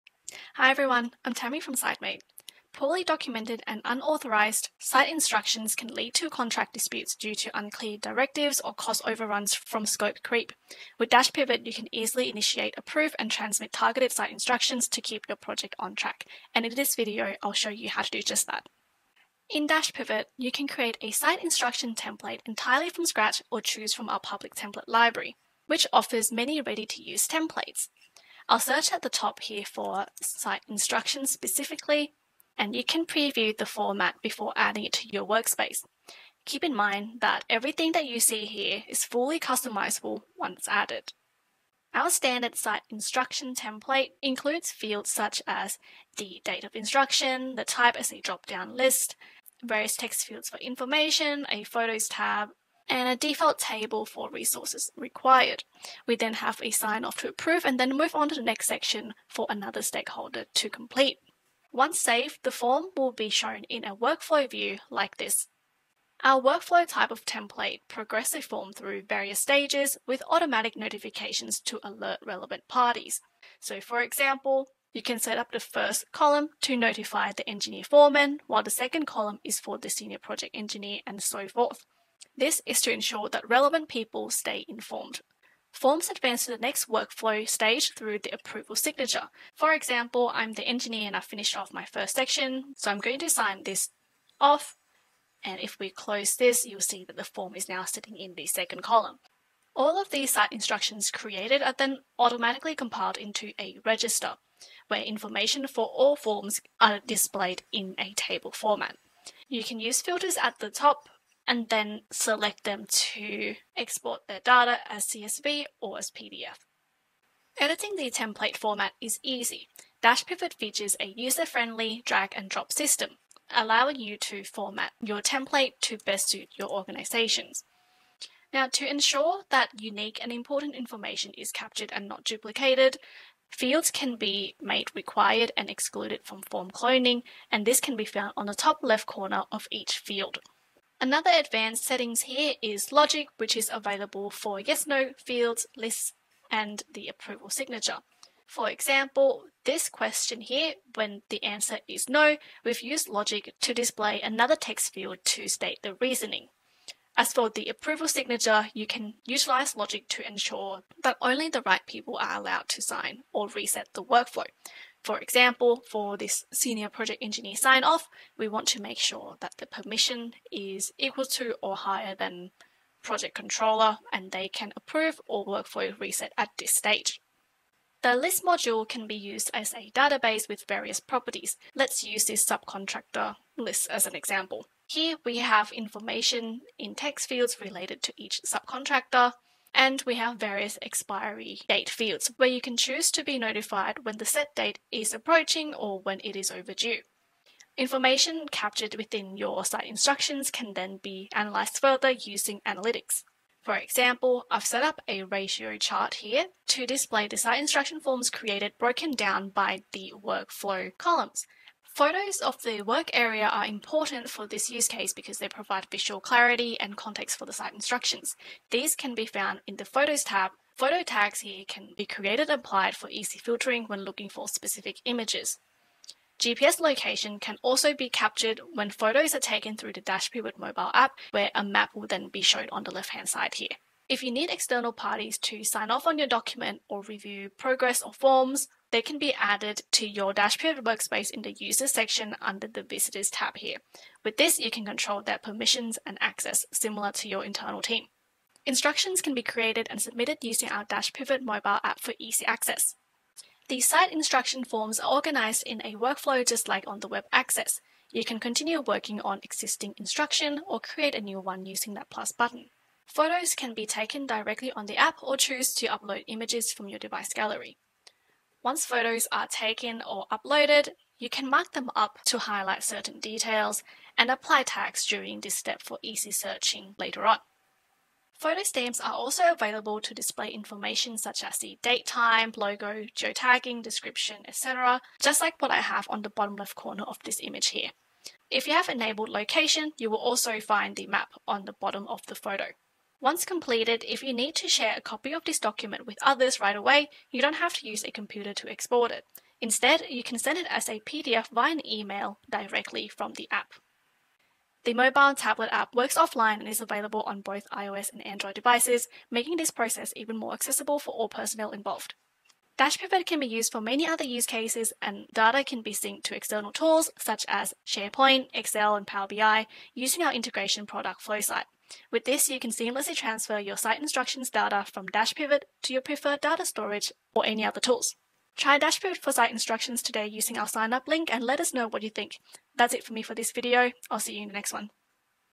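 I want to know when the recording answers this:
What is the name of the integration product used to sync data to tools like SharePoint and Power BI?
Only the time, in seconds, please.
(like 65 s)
321 s.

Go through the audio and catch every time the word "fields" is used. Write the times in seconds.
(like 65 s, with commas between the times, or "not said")
44 s, 50 s, 133 s, 139 s, 145 s, 154 s, 187 s, 191 s.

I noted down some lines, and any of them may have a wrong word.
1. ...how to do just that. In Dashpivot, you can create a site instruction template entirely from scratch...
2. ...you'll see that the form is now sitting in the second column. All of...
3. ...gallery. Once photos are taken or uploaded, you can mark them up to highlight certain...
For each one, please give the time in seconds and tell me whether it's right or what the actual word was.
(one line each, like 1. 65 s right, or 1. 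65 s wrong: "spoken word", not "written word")
1. 17 s right
2. 96 s right
3. 267 s right.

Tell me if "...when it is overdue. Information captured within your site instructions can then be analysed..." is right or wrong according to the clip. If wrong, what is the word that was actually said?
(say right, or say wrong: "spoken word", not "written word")
right.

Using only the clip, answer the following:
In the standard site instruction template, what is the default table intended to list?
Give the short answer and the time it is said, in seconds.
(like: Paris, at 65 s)
Resources required, at 54 s.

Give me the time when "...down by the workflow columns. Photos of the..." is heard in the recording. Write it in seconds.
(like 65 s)
209 s.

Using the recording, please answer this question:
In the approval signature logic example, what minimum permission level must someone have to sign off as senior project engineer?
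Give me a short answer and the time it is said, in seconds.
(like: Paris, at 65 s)
Project controller, at 173 s.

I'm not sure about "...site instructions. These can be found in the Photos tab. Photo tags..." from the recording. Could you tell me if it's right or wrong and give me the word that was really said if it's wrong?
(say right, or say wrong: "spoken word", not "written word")
right.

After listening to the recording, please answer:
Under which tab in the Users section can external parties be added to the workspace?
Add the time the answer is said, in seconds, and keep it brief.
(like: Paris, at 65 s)
Visitors, at 242 s.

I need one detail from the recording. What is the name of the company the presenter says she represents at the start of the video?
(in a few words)
Sitemate.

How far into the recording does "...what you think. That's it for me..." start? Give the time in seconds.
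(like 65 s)
331 s.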